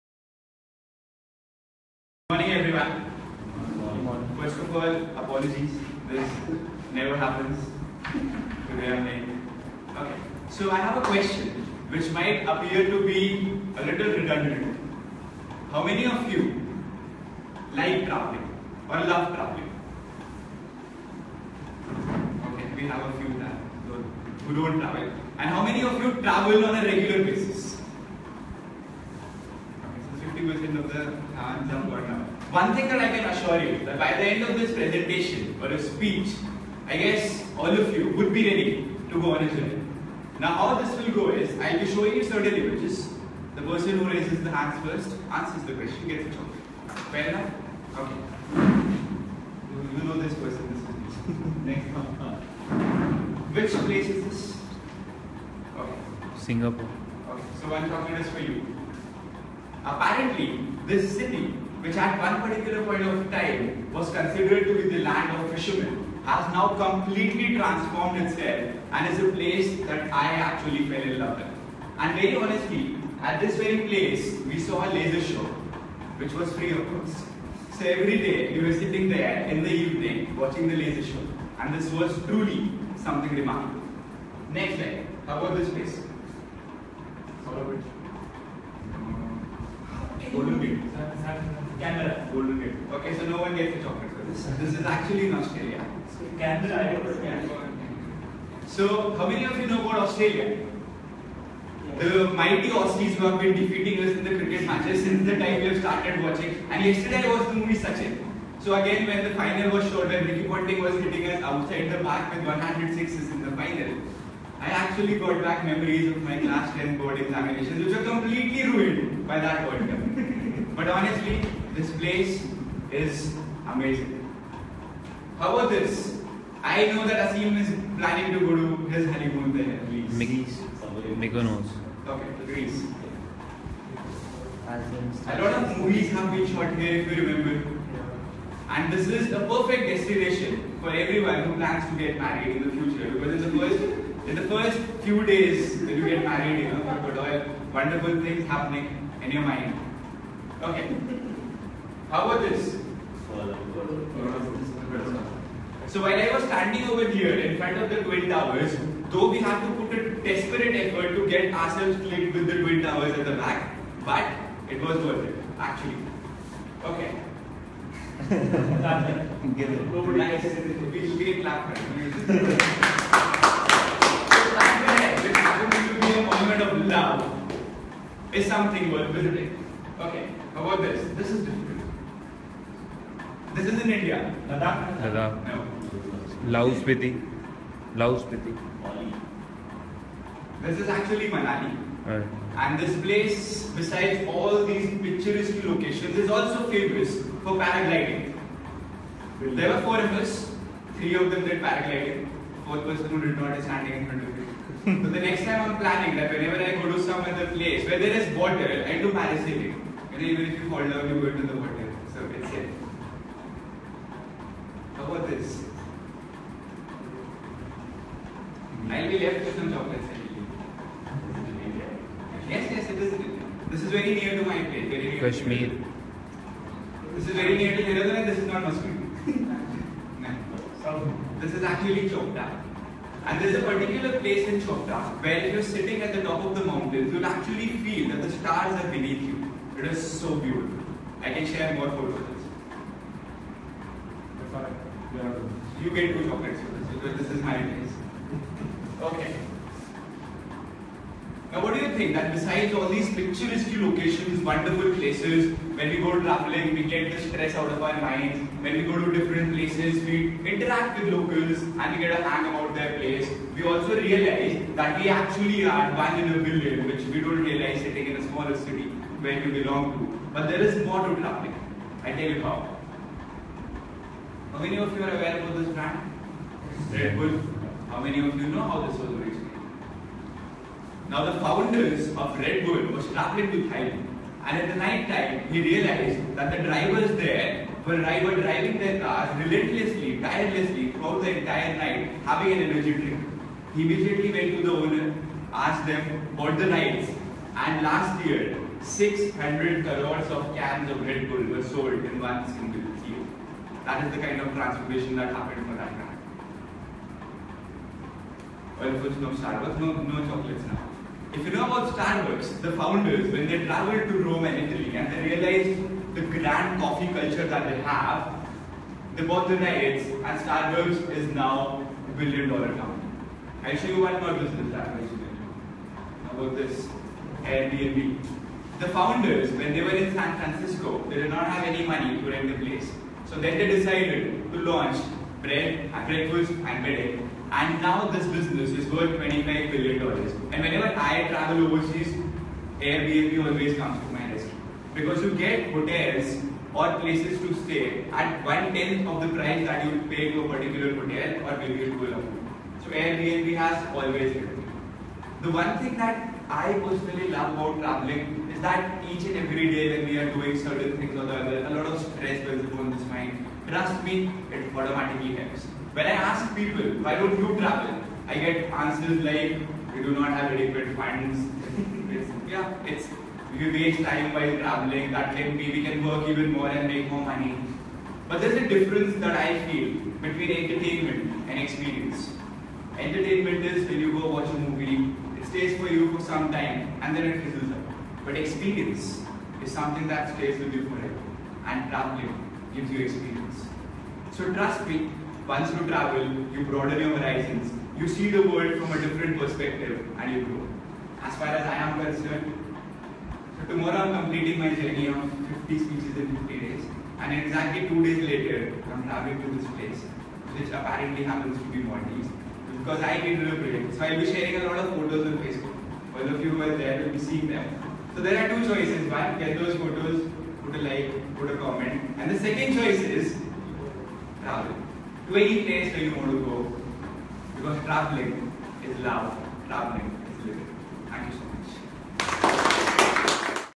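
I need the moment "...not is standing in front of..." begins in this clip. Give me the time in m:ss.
3:23.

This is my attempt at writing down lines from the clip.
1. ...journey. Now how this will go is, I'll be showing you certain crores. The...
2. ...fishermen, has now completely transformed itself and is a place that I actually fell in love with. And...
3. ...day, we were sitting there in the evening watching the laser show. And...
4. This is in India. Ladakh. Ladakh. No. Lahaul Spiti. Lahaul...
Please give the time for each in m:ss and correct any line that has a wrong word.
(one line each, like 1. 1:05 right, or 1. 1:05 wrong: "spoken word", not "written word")
1. 0:39 wrong: "images", not "crores"
2. 1:05 right
3. 1:18 right
4. 3:03 right.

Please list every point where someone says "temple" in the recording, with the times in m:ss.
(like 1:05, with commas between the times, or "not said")
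not said.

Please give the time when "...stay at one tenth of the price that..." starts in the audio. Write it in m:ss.
5:47.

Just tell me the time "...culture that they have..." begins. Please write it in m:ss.
5:17.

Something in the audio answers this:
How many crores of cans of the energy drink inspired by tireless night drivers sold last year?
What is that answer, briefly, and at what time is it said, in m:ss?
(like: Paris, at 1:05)
600 crores, at 4:58.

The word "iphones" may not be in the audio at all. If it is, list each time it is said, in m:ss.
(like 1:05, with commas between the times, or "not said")
not said.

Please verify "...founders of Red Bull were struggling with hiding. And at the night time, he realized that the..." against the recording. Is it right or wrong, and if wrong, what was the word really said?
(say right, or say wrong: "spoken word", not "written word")
right.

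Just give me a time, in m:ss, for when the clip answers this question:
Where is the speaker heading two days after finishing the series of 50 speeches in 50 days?
6:51.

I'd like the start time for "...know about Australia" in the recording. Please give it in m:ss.
1:39.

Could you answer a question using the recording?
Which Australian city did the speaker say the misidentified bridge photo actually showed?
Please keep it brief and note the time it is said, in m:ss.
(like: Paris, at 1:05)
Canberra, at 1:36.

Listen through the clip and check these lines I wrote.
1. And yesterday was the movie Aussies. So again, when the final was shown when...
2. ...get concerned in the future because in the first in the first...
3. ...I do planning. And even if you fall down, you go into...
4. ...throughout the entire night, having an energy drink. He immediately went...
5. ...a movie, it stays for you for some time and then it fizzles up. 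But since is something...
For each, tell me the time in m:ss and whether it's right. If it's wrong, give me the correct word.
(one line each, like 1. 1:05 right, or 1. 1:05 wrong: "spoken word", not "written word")
1. 1:46 wrong: "Sachin", not "Aussies"
2. 2:21 wrong: "married", not "concerned"
3. 3:28 wrong: "parasailing", not "planning"
4. 4:50 right
5. 6:24 wrong: "experience", not "since".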